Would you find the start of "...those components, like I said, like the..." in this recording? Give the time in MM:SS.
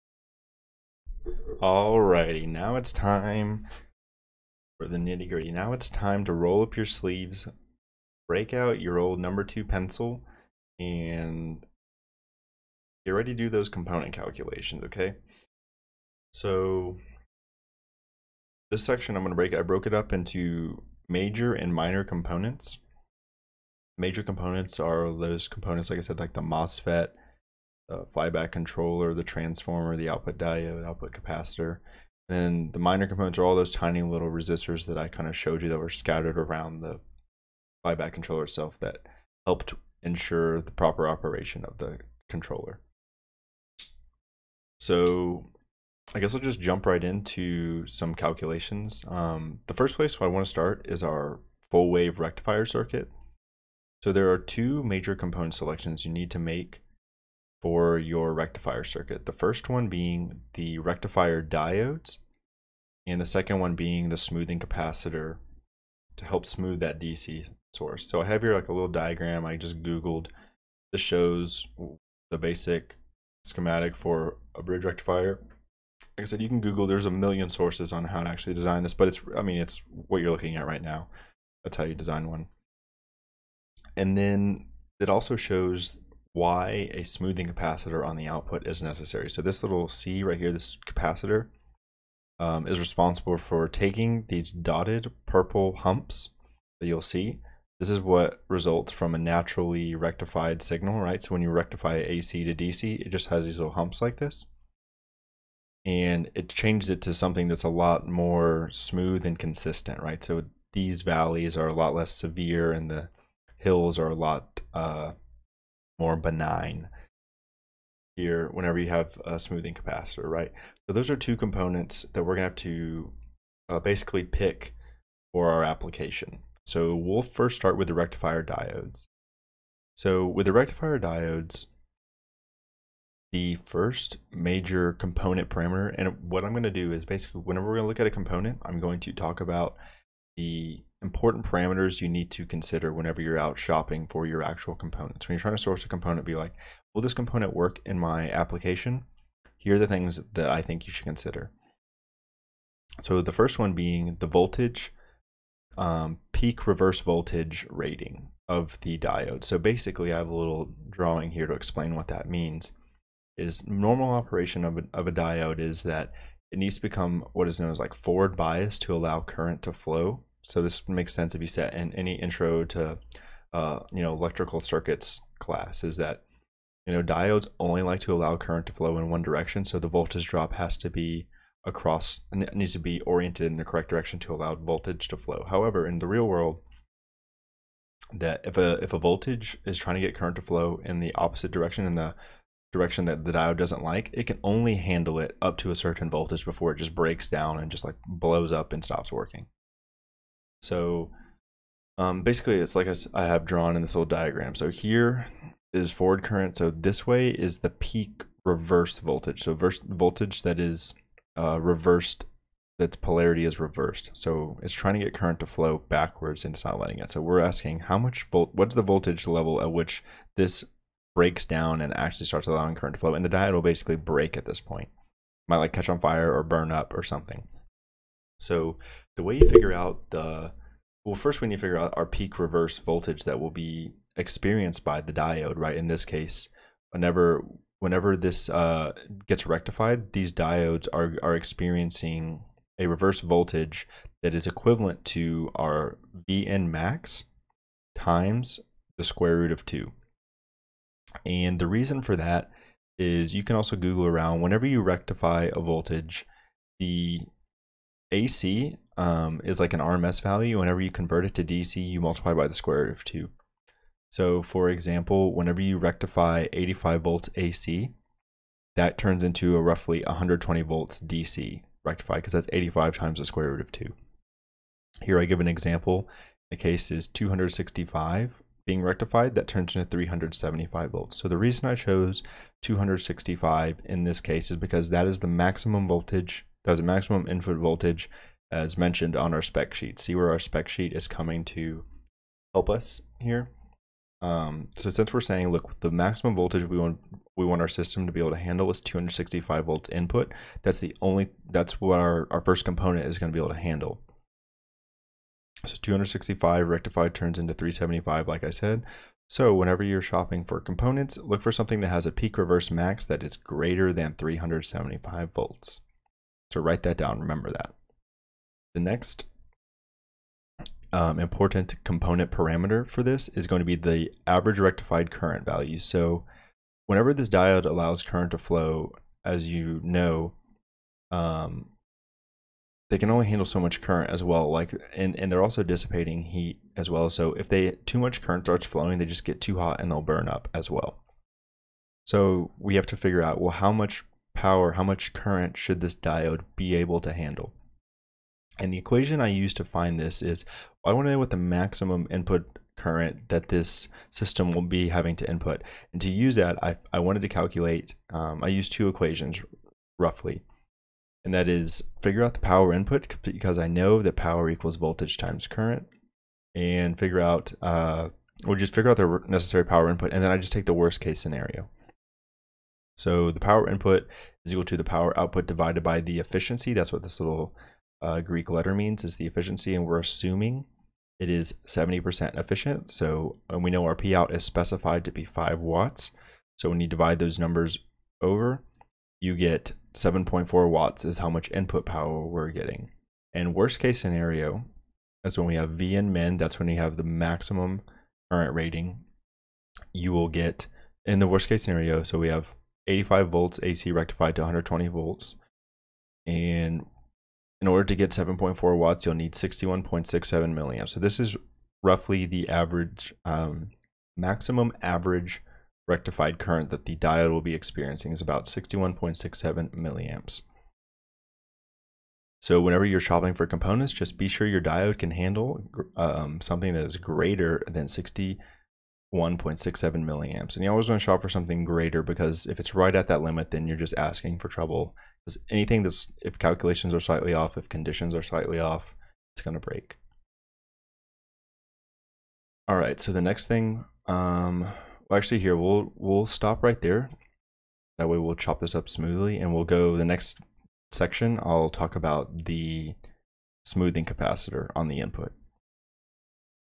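00:25.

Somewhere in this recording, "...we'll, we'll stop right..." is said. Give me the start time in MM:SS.
07:25.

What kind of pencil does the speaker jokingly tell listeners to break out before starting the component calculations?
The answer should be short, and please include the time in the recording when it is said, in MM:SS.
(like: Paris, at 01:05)
number two pencil, at 00:09.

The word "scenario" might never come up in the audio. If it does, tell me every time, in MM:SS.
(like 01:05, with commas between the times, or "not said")
06:11, 06:33, 06:41.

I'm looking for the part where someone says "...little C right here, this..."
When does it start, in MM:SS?
01:29.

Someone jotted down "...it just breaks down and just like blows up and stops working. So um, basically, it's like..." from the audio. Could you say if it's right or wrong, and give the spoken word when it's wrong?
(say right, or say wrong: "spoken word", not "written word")
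right.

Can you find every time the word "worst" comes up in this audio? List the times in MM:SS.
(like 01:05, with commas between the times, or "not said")
06:10, 06:33, 06:41.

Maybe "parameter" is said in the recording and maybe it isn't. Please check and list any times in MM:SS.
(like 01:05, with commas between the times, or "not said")
02:15, 02:21, 05:22.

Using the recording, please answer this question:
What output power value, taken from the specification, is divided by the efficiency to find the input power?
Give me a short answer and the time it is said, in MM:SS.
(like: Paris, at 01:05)
5 watts, at 06:25.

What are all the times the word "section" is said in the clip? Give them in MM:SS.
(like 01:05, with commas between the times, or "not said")
00:18, 07:30.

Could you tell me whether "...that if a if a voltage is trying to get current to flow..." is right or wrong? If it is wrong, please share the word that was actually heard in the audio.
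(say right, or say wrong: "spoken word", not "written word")
right.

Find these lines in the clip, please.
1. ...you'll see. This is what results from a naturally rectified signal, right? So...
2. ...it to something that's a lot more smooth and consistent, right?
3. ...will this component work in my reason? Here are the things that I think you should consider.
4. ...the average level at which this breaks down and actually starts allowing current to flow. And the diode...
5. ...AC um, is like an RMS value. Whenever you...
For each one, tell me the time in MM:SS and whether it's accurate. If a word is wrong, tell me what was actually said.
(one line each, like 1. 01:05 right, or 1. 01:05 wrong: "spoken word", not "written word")
1. 01:36 right
2. 01:46 right
3. 02:26 wrong: "application", not "reason"
4. 03:38 wrong: "voltage", not "average"
5. 04:18 right.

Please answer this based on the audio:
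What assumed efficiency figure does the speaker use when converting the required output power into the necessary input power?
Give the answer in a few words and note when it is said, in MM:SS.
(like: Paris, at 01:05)
70%, at 06:21.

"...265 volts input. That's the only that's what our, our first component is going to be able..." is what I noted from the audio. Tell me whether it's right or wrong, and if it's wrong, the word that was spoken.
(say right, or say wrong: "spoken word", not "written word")
right.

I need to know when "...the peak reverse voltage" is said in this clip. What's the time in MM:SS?
03:27.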